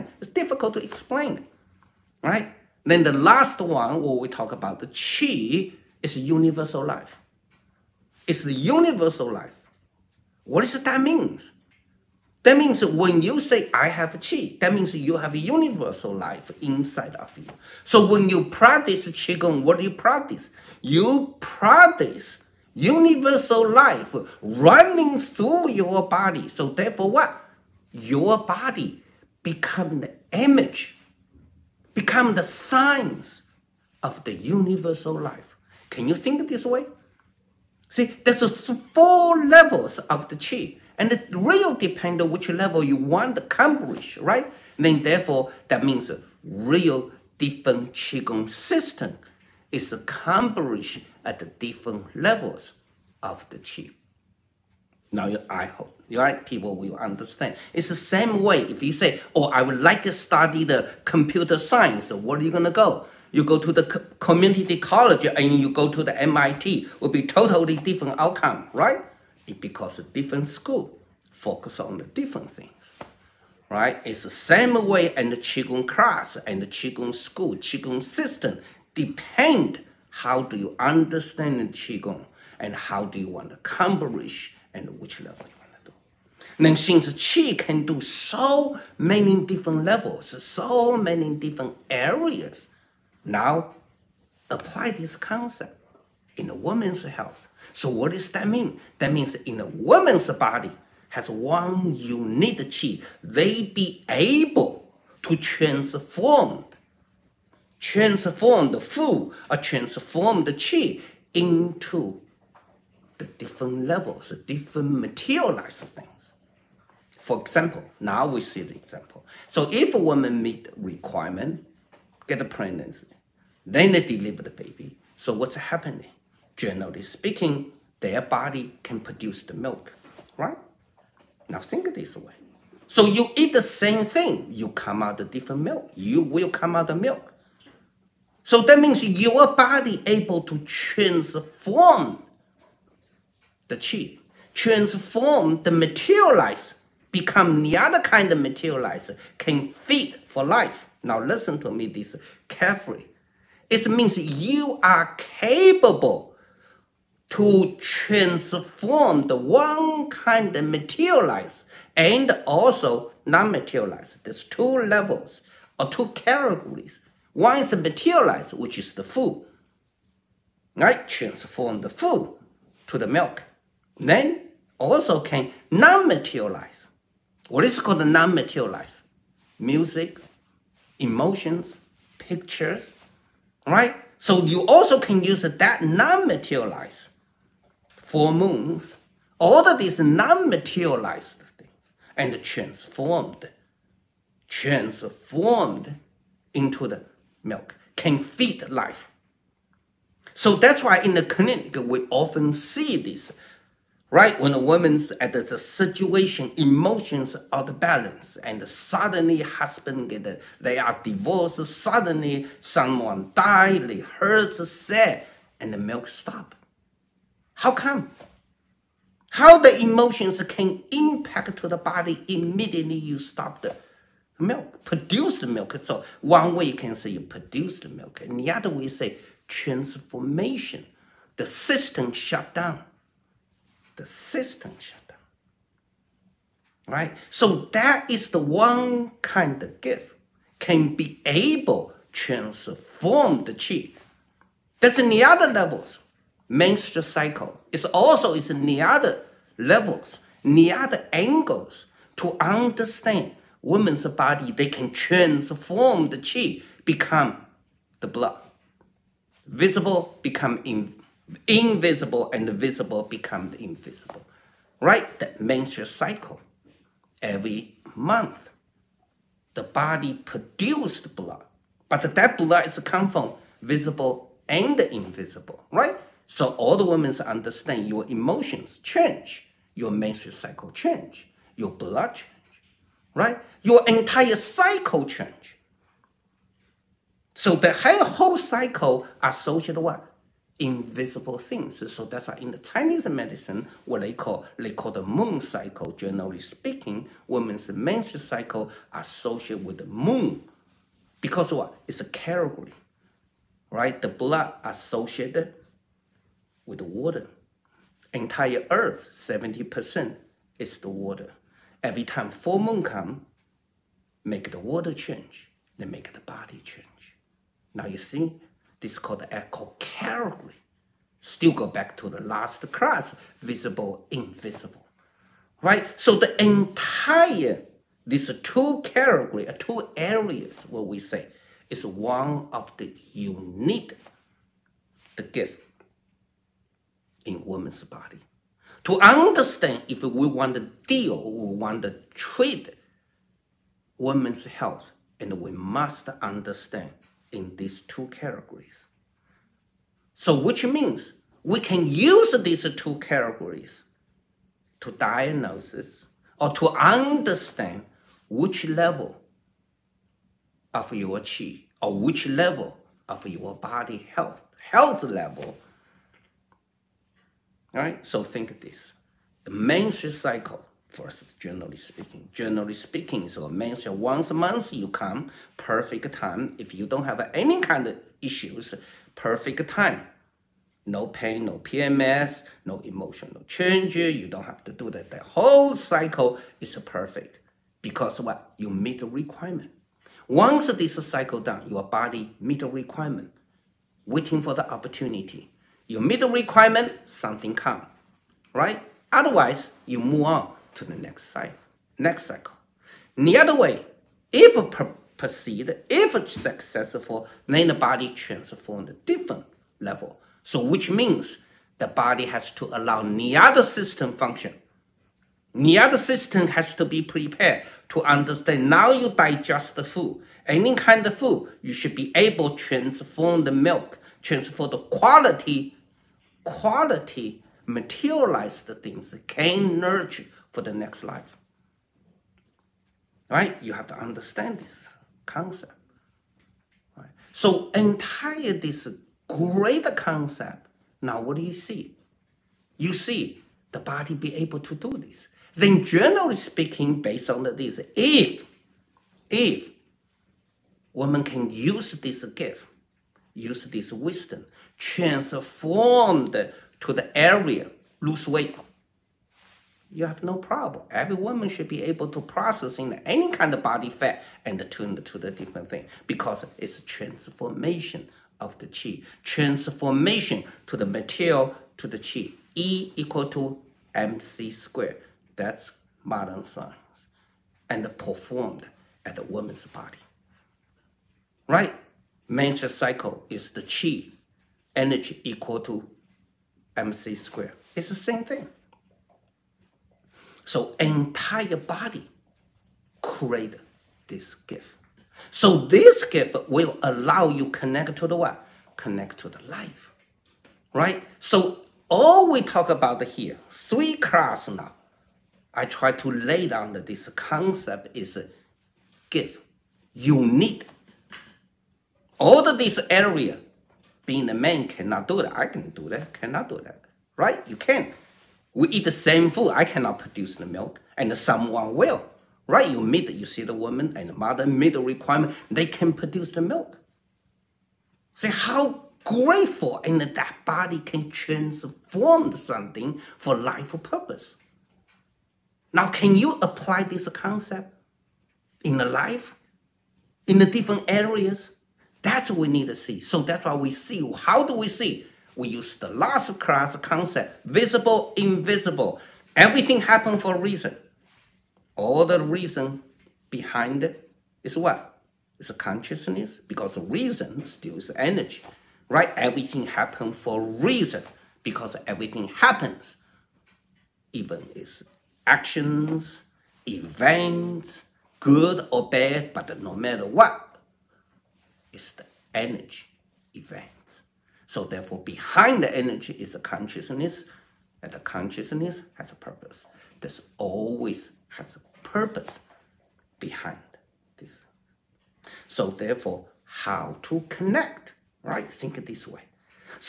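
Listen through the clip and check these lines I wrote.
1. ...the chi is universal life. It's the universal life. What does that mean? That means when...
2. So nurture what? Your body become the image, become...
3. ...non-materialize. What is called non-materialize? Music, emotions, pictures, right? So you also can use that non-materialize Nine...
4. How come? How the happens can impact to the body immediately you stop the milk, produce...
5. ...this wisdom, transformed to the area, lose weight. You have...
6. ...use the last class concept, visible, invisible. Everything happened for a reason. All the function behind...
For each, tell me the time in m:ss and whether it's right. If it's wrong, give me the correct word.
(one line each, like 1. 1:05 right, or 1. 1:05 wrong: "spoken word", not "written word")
1. 0:04 right
2. 0:26 wrong: "therefore", not "nurture"
3. 2:55 wrong: "Four", not "Nine"
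4. 3:37 wrong: "emotions", not "happens"
5. 7:33 right
6. 9:05 wrong: "reason", not "function".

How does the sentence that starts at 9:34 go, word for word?
So therefore, behind the energy is a consciousness, and the consciousness has a purpose.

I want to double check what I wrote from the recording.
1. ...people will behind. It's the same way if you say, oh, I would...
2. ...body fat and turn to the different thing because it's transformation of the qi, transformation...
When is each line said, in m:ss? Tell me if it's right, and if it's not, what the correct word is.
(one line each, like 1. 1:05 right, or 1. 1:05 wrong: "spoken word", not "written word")
1. 0:56 wrong: "understand", not "behind"
2. 7:43 right.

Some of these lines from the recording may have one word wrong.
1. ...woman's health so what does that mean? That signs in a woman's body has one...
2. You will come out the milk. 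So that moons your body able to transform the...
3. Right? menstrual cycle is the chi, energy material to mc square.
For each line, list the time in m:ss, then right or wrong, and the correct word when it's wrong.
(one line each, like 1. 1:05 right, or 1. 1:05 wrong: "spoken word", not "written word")
1. 1:36 wrong: "means", not "signs"
2. 2:15 wrong: "means", not "moons"
3. 8:01 wrong: "equal", not "material".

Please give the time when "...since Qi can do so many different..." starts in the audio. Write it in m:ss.
1:26.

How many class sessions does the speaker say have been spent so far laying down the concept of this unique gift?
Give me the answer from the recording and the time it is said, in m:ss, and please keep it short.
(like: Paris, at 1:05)
3, at 8:23.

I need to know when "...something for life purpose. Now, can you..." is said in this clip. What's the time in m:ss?
8:52.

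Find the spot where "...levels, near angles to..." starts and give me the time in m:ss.
4:09.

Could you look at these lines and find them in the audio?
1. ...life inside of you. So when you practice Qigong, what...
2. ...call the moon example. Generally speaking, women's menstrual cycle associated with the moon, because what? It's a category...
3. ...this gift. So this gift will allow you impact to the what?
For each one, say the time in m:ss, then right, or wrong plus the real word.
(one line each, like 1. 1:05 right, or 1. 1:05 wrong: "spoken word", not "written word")
1. 0:16 right
2. 4:54 wrong: "cycle", not "example"
3. 8:14 wrong: "connect", not "impact".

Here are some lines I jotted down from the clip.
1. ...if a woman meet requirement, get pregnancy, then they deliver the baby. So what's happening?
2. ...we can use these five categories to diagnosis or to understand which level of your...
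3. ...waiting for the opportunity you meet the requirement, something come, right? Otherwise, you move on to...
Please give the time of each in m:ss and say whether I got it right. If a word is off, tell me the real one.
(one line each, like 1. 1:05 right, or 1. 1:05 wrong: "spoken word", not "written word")
1. 1:59 right
2. 5:51 wrong: "two", not "five"
3. 6:34 right.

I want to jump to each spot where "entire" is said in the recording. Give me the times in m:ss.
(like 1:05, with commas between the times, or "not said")
4:43, 5:08, 5:26, 7:17, 8:10.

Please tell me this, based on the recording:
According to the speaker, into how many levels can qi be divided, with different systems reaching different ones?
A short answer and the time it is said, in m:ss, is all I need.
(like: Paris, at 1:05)
4, at 0:38.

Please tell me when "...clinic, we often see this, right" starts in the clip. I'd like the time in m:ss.
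3:21.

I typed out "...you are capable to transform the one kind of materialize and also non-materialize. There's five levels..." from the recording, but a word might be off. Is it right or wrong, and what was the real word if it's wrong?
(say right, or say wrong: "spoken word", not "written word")
wrong: "two", not "five".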